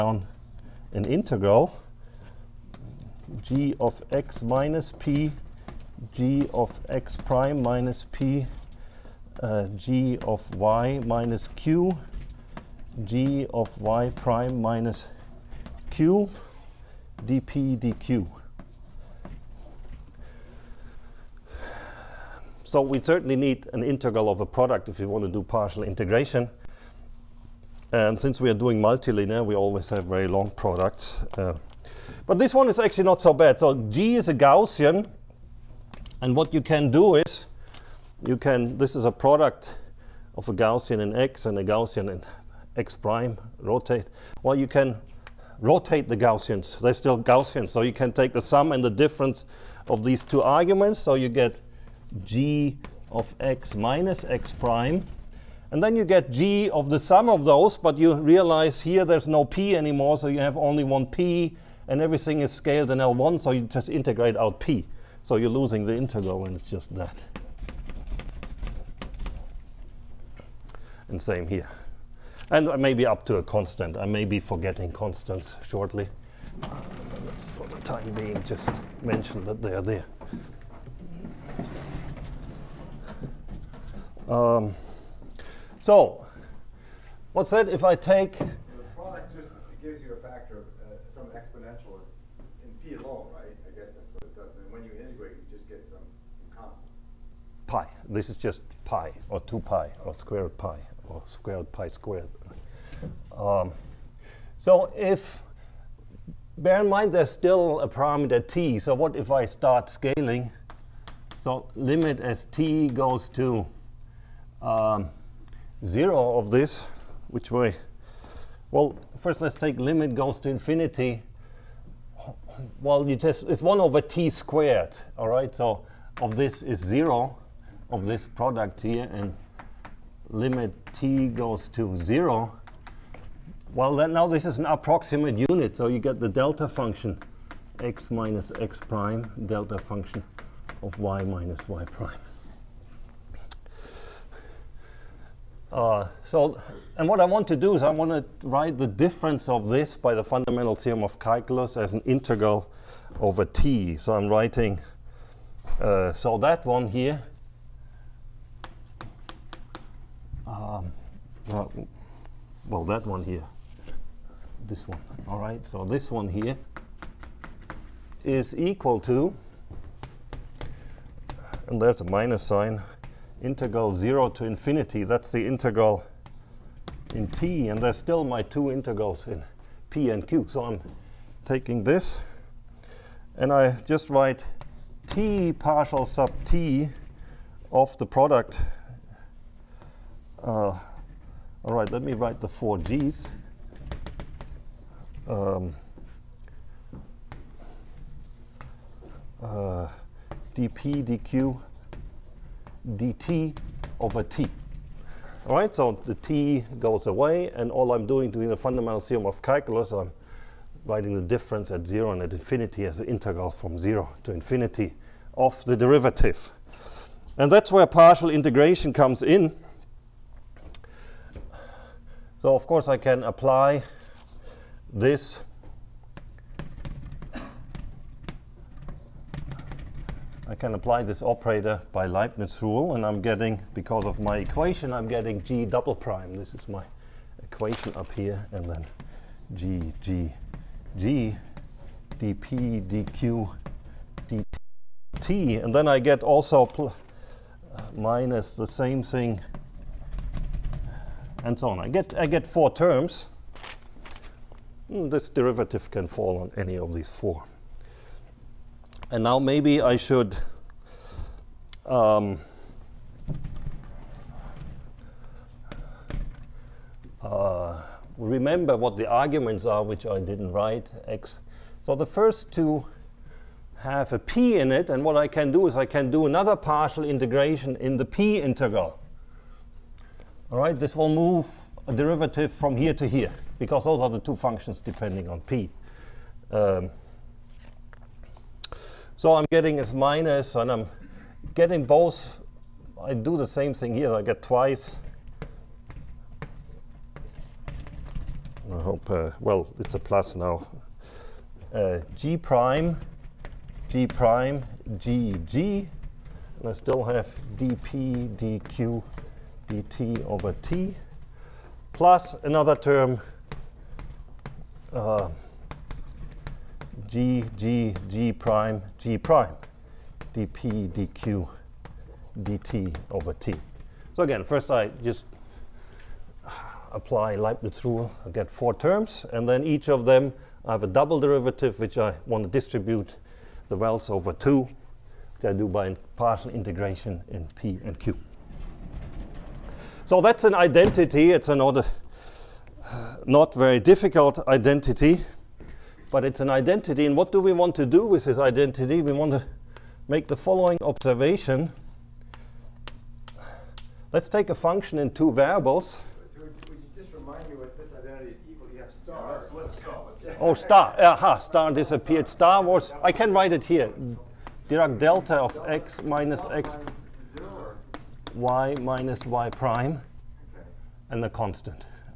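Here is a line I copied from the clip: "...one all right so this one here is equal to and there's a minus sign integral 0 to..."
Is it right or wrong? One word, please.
right.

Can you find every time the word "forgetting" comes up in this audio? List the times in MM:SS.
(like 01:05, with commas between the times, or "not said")
01:14.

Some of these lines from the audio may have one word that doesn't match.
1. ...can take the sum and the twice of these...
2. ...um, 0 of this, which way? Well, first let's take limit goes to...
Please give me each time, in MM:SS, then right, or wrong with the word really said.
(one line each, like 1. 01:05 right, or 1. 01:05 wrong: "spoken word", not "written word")
1. 00:47 wrong: "difference", not "twice"
2. 01:54 right.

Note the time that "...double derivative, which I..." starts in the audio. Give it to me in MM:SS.
05:30.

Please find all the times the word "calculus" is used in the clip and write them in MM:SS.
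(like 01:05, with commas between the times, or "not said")
02:31, 03:29.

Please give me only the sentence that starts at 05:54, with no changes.
Let's take a function in two variables.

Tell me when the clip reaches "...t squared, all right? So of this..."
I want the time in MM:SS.
02:04.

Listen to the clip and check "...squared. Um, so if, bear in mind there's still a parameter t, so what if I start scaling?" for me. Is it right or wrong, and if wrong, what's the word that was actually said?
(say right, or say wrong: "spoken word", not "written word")
right.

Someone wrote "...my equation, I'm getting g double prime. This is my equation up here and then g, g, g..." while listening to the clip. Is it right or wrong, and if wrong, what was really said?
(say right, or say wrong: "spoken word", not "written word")
right.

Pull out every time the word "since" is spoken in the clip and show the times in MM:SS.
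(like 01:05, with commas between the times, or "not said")
00:28.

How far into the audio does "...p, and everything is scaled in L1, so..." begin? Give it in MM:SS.
01:01.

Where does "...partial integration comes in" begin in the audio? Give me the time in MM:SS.
03:37.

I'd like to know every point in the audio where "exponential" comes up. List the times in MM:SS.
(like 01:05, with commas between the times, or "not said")
01:31.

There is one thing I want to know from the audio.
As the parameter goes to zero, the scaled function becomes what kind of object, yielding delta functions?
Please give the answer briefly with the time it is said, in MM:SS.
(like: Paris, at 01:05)
approximate unit, at 02:14.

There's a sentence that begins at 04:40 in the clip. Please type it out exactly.
All right, this will move a derivative from here to here because those are the two functions depending on p.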